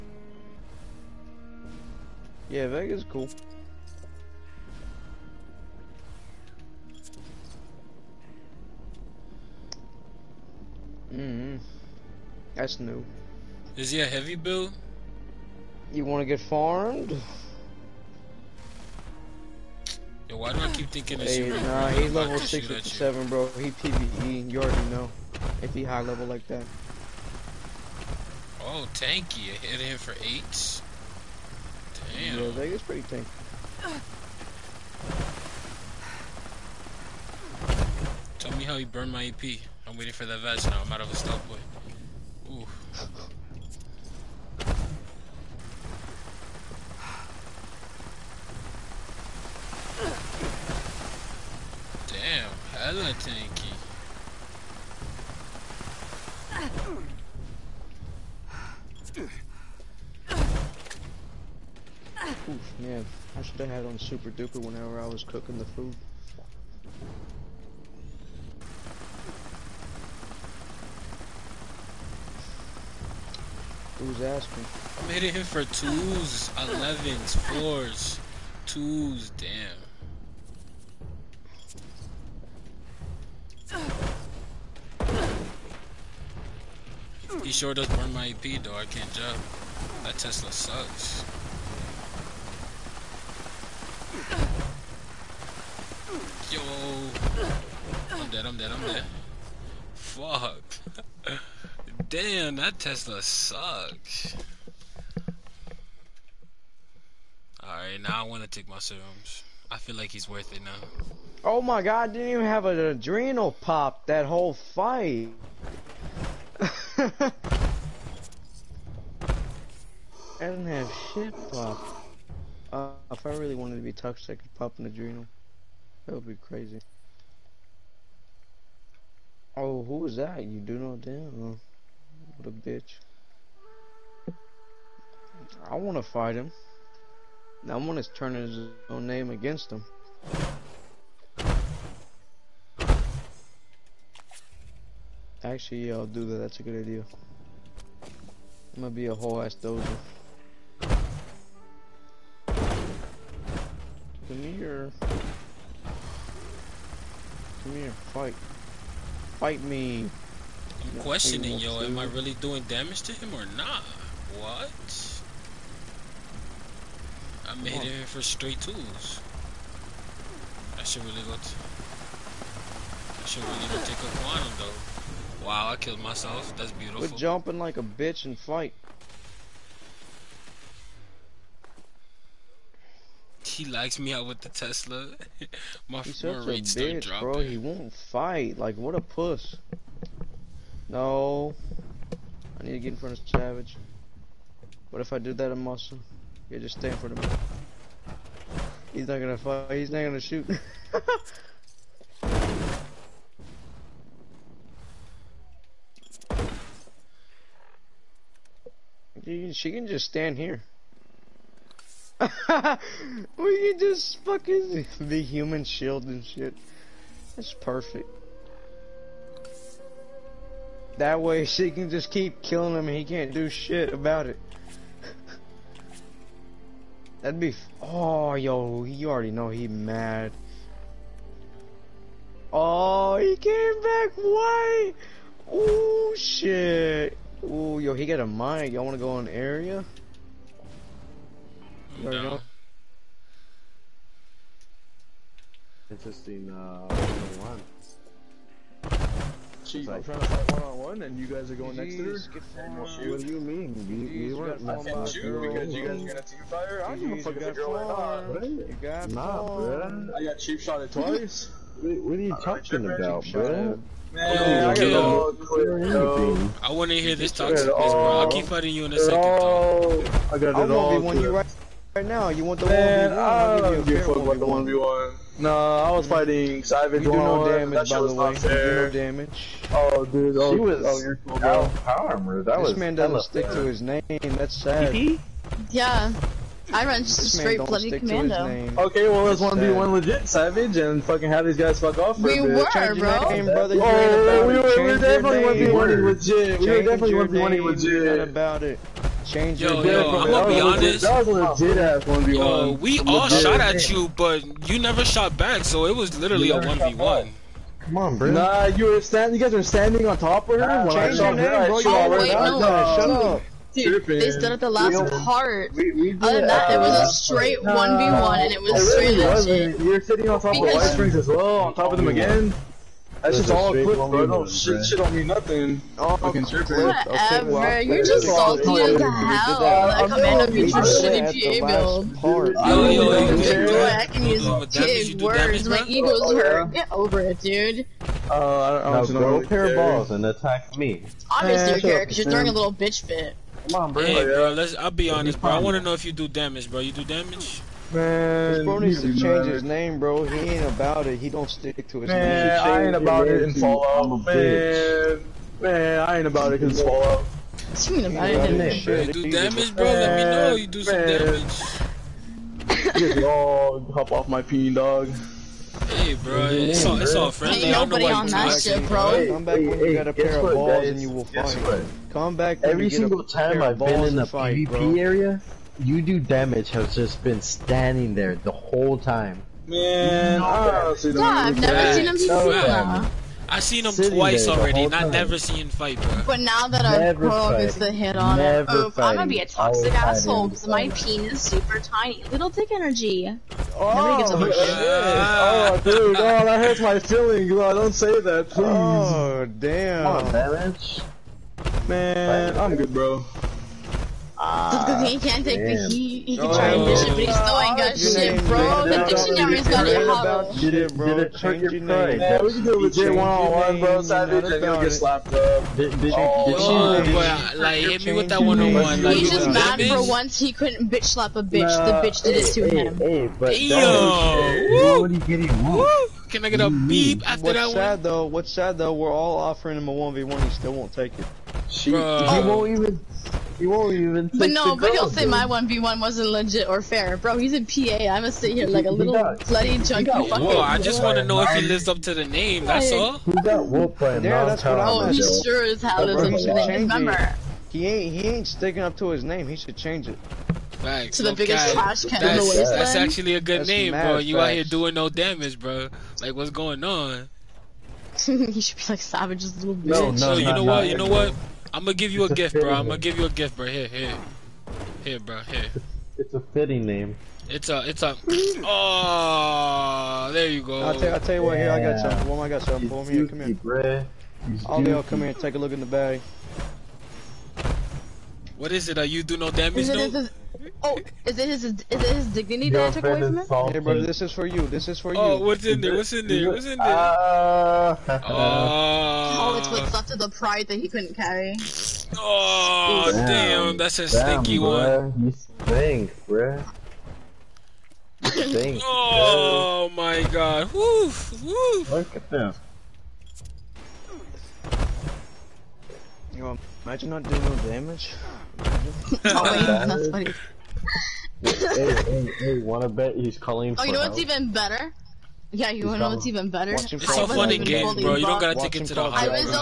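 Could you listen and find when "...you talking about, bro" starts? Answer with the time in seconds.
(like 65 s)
262 s.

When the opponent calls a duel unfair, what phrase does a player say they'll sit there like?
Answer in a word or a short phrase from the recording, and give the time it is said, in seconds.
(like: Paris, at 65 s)
bloody junkie, at 439 s.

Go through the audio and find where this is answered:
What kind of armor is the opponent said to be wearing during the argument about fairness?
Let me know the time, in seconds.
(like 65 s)
281 s.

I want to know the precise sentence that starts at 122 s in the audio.
Uh, if I really wanted to be toxic, I could pop an adrenal.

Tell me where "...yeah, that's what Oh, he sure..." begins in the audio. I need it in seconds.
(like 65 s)
444 s.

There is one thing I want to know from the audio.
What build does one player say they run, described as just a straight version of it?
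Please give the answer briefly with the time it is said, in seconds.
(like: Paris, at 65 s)
bloody commando, at 287 s.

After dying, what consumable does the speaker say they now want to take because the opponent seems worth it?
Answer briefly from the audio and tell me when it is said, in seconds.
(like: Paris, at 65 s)
serums, at 108 s.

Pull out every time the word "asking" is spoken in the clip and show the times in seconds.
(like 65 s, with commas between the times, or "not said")
74 s.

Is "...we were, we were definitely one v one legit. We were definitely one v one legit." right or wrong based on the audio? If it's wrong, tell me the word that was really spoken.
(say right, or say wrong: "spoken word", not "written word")
right.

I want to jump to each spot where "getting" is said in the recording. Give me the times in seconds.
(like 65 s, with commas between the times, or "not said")
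425 s.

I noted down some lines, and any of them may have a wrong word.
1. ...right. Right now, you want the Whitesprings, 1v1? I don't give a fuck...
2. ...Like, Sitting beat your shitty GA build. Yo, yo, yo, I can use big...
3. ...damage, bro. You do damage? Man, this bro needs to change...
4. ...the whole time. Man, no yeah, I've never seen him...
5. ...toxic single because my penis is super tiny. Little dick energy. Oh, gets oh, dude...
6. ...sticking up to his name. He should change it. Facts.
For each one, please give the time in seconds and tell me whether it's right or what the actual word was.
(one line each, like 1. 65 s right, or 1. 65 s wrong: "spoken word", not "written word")
1. 271 s wrong: "Man", not "Whitesprings"
2. 330 s wrong: "Amanda", not "Sitting"
3. 346 s right
4. 378 s right
5. 389 s wrong: "asshole", not "single"
6. 448 s right.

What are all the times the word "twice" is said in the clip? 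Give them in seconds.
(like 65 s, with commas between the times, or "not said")
260 s, 384 s.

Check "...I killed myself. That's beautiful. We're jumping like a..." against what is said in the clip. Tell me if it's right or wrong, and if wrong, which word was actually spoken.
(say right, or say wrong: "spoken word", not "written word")
right.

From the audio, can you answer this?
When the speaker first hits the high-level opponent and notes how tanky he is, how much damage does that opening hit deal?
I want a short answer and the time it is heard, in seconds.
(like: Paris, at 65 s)
8, at 30 s.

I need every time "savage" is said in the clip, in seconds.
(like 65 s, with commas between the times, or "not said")
193 s, 276 s, 290 s, 414 s, 459 s.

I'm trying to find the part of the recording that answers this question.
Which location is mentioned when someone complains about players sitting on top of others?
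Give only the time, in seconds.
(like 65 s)
320 s.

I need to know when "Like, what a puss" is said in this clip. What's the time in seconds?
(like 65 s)
188 s.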